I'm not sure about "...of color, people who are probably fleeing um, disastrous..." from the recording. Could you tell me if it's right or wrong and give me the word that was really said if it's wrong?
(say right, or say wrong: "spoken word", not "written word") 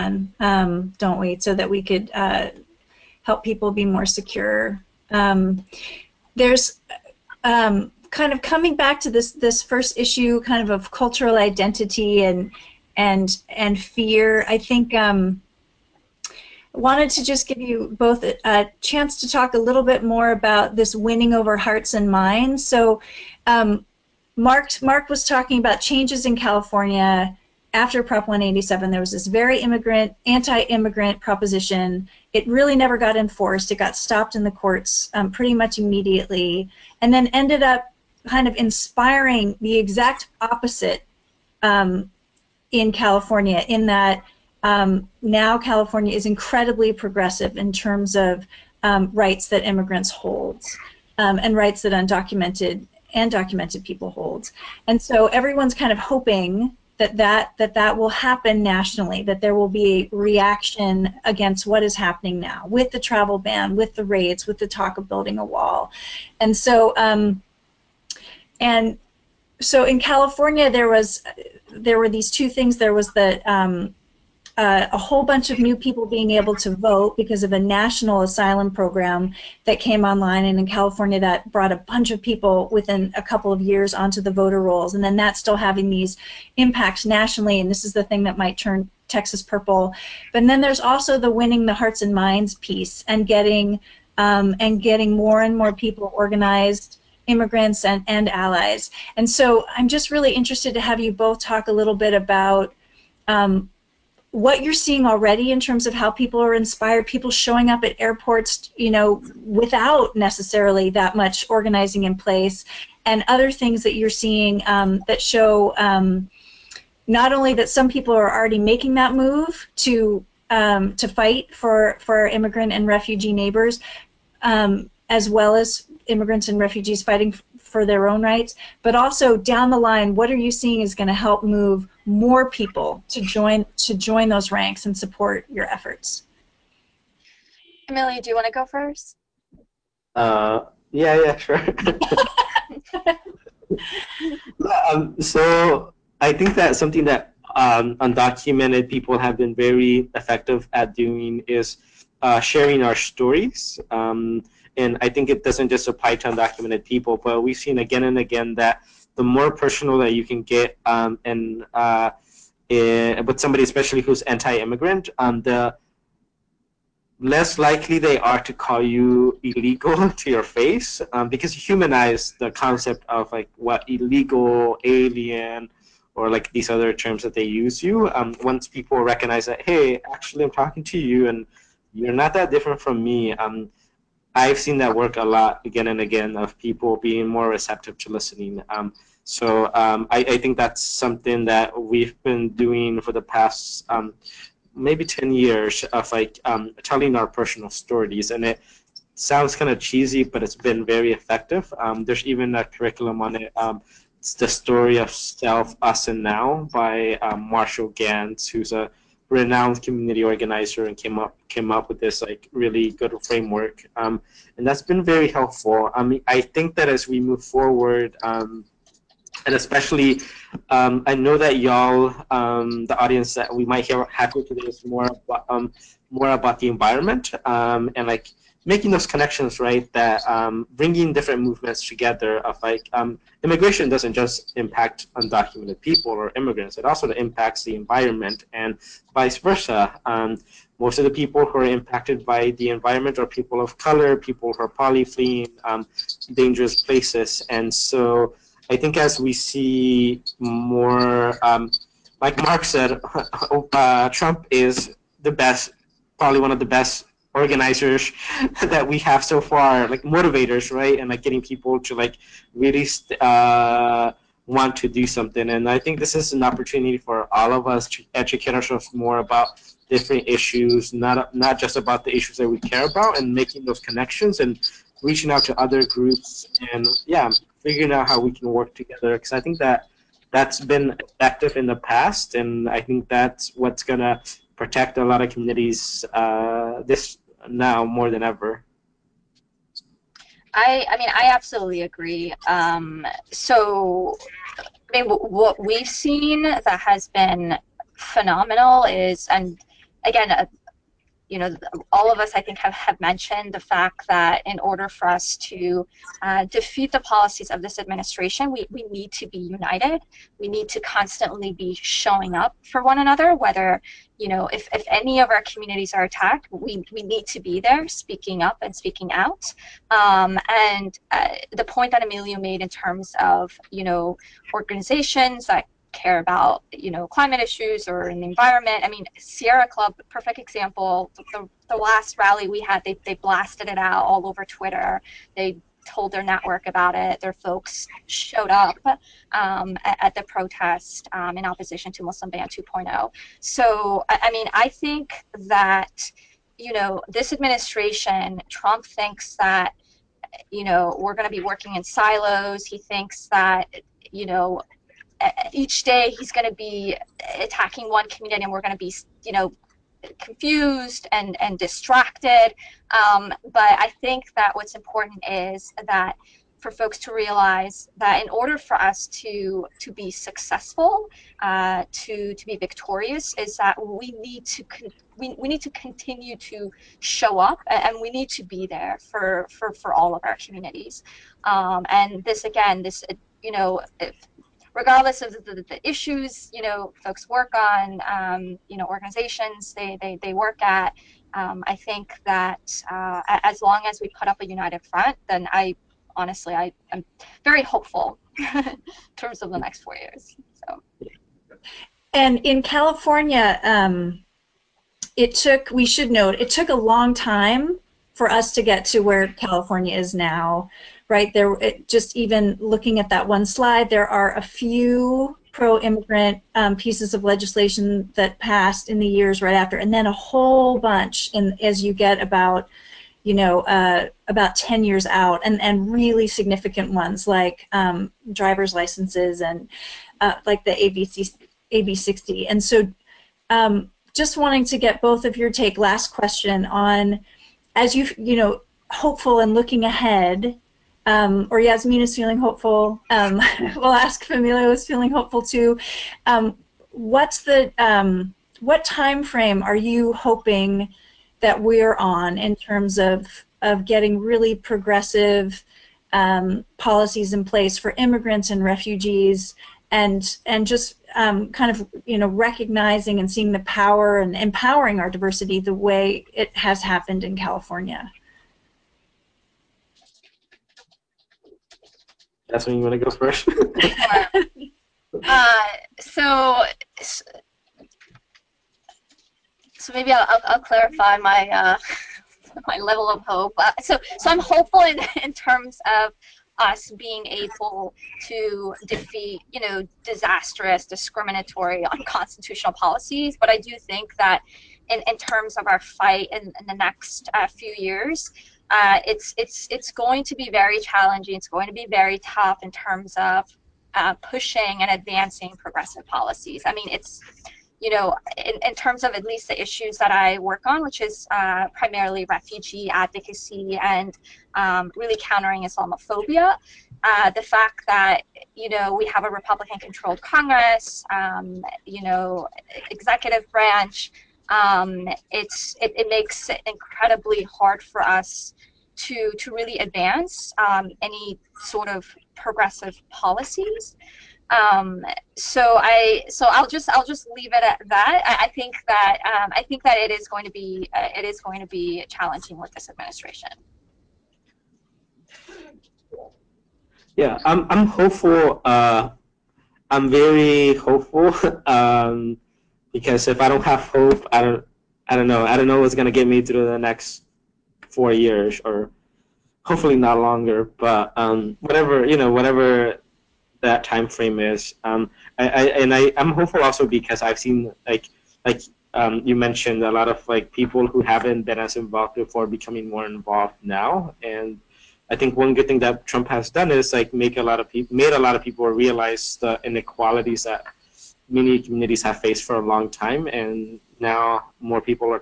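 wrong: "dangerous", not "disastrous".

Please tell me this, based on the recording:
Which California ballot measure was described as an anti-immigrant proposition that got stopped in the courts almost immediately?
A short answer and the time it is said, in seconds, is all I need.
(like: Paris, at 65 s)
Prop 187, at 28 s.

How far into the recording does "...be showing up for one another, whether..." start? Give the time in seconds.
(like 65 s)
311 s.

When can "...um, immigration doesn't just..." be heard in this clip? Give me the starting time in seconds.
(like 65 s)
232 s.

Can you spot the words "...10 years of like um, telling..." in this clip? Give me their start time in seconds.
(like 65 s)
195 s.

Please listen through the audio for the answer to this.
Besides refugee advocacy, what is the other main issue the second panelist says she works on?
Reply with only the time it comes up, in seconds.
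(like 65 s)
515 s.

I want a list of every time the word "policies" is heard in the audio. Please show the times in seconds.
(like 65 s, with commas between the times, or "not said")
306 s, 456 s, 492 s, 506 s, 533 s.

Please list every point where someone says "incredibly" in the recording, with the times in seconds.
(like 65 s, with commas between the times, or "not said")
46 s, 526 s.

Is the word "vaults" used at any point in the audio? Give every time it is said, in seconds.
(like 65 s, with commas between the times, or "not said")
not said.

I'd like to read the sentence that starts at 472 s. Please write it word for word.
That's when you want to go first?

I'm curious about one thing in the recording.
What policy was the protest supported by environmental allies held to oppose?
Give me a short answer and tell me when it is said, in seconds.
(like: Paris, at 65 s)
Muslim Ban 2.0, at 342 s.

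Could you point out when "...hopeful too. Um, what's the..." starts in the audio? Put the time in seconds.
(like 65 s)
445 s.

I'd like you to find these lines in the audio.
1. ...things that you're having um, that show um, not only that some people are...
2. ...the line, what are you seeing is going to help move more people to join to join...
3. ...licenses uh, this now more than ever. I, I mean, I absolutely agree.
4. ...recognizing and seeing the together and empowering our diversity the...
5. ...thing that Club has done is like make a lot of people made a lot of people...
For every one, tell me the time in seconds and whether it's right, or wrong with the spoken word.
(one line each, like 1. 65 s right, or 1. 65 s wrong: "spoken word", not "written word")
1. 113 s wrong: "seeing", not "having"
2. 129 s right
3. 285 s wrong: "communities", not "licenses"
4. 462 s wrong: "power", not "together"
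5. 575 s wrong: "Trump", not "Club".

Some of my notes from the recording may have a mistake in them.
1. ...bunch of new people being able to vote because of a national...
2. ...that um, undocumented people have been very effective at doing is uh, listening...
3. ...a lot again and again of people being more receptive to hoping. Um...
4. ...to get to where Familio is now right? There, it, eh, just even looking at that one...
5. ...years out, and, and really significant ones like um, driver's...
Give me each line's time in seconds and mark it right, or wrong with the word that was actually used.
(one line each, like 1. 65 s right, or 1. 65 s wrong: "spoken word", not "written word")
1. 75 s right
2. 147 s wrong: "sharing", not "listening"
3. 185 s wrong: "listening", not "hoping"
4. 408 s wrong: "California", not "Familio"
5. 424 s right.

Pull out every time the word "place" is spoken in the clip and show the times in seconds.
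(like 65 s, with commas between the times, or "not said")
112 s, 246 s, 457 s.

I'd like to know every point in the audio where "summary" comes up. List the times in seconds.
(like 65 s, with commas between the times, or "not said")
not said.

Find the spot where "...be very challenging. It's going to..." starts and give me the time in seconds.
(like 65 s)
500 s.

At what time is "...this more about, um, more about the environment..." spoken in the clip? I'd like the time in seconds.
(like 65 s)
224 s.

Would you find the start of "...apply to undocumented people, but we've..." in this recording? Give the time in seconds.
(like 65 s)
155 s.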